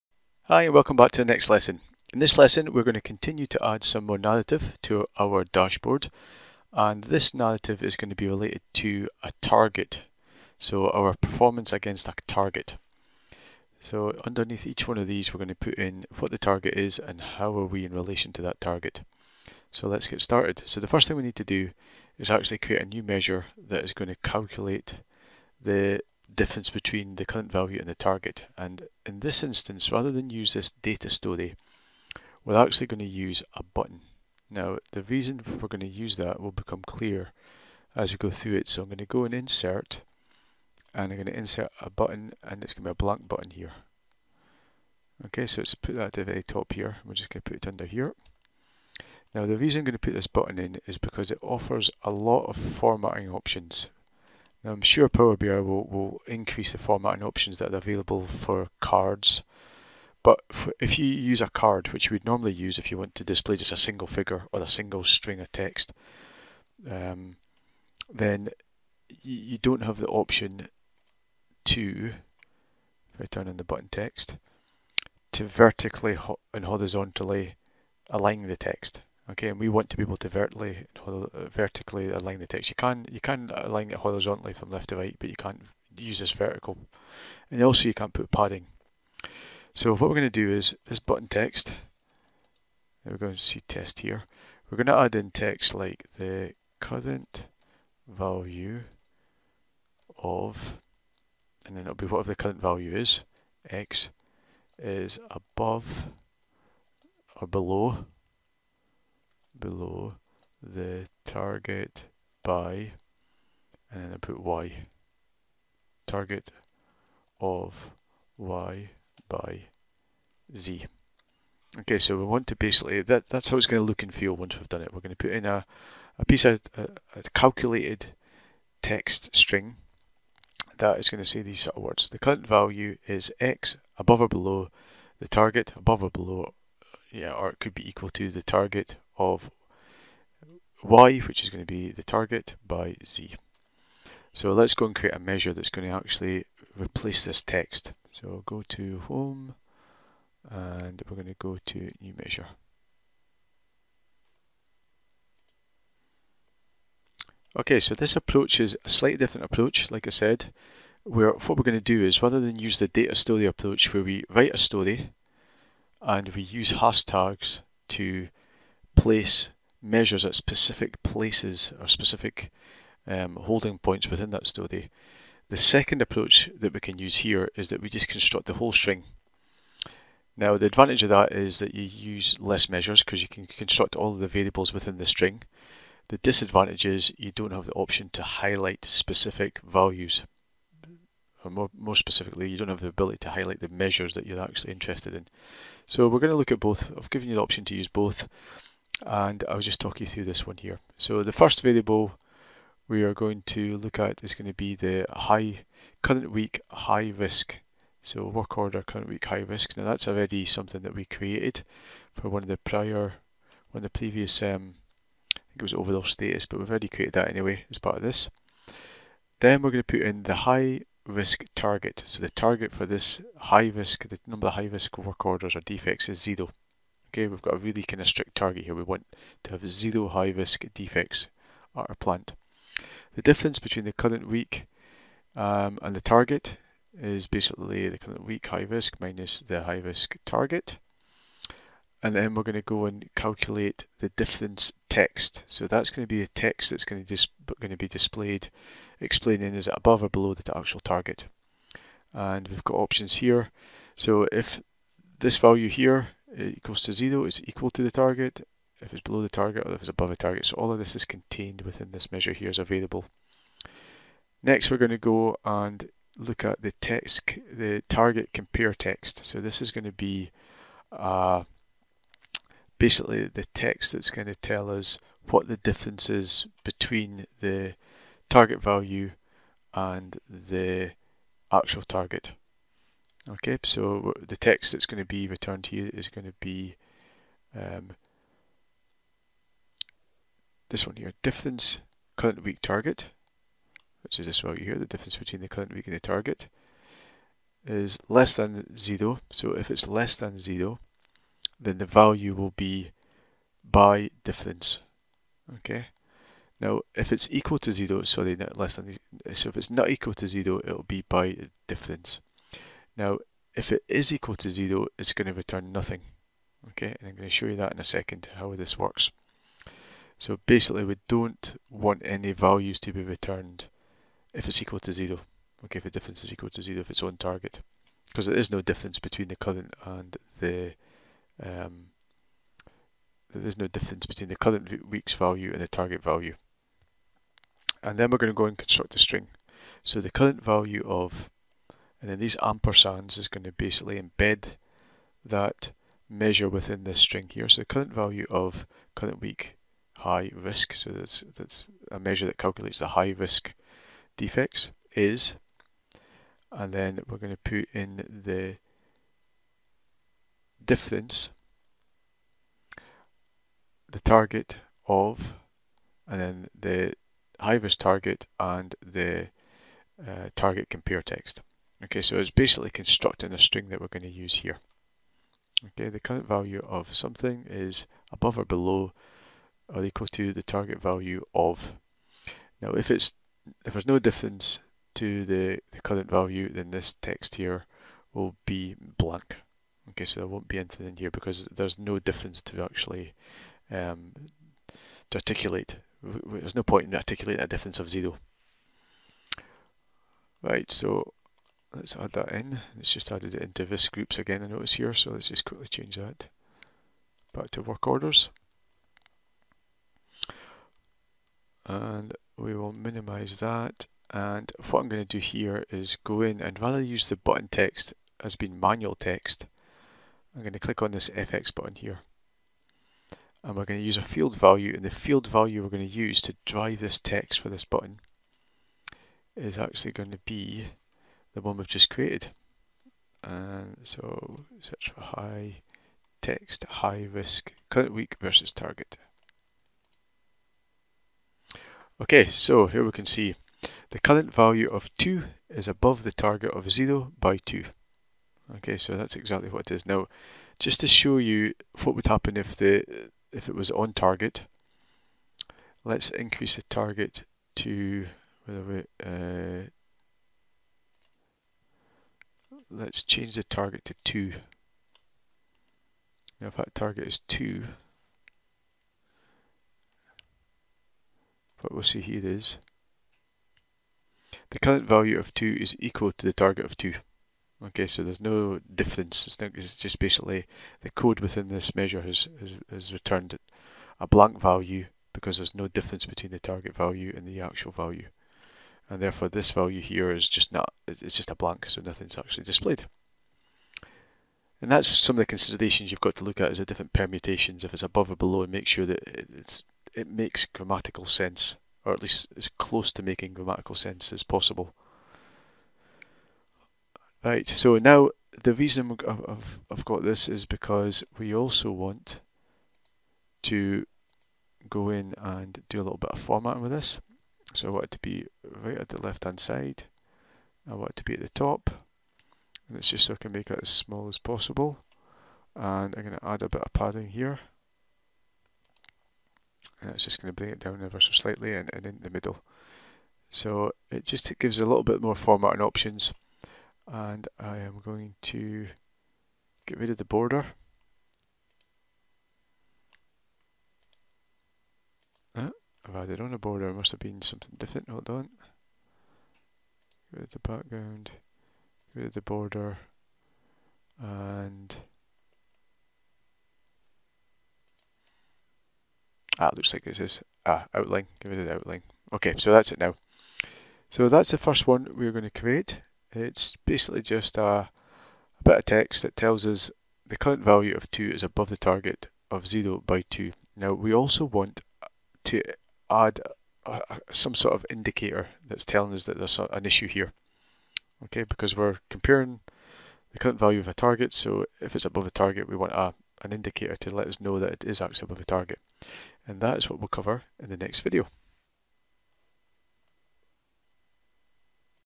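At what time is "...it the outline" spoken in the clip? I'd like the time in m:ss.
9:21.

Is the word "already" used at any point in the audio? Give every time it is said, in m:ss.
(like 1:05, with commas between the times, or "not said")
3:30, 3:36.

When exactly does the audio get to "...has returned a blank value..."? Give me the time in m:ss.
8:02.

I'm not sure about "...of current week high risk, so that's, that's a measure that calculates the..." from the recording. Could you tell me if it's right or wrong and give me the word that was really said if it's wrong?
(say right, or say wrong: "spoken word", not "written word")
right.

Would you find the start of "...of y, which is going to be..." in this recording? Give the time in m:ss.
2:19.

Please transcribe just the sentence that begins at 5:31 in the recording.
Um, there's no difference between the current week's value and the target value.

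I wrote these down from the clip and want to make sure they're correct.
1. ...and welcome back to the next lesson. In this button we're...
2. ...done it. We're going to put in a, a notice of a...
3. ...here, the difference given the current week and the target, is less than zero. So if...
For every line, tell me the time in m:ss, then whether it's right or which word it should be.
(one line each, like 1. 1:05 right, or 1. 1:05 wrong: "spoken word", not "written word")
1. 0:00 wrong: "lesson", not "button"
2. 2:04 wrong: "piece", not "notice"
3. 4:54 wrong: "between", not "given".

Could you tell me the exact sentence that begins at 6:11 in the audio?
Okay, so it's basically constructing a string that we're going to use here.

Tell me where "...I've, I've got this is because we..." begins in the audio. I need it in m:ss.
8:29.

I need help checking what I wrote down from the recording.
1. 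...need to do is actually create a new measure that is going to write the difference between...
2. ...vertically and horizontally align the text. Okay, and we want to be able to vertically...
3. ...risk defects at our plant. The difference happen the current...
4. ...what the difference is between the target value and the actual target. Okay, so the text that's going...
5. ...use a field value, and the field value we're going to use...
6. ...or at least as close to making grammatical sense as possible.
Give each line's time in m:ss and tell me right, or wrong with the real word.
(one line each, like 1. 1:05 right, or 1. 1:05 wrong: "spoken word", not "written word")
1. 0:21 wrong: "calculate", not "write"
2. 1:15 right
3. 3:50 wrong: "between", not "happen"
4. 4:35 right
5. 7:03 right
6. 8:21 right.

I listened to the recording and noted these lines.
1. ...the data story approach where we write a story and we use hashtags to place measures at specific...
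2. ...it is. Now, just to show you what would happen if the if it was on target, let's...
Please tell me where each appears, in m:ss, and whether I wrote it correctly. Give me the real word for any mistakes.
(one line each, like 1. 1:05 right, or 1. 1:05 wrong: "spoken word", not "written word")
1. 2:42 right
2. 7:29 right.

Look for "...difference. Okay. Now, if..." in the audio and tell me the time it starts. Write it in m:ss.
5:04.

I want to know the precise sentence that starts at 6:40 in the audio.
Right, so Let's add that in.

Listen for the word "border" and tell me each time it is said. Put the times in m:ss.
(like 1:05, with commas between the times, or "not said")
9:00, 9:06, 9:12.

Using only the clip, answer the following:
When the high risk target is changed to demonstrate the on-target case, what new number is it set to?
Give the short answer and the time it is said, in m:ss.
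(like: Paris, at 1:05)
2, at 7:43.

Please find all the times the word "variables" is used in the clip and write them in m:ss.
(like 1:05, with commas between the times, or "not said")
3:04, 3:21.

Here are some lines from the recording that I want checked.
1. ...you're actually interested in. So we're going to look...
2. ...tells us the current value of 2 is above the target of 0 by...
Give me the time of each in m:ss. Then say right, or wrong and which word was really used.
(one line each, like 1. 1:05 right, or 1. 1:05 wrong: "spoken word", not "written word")
1. 3:14 right
2. 9:29 right.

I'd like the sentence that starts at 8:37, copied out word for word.
So I want it to be right at the left hand side.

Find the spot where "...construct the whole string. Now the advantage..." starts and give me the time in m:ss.
2:58.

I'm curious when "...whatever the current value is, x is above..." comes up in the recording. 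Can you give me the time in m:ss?
1:42.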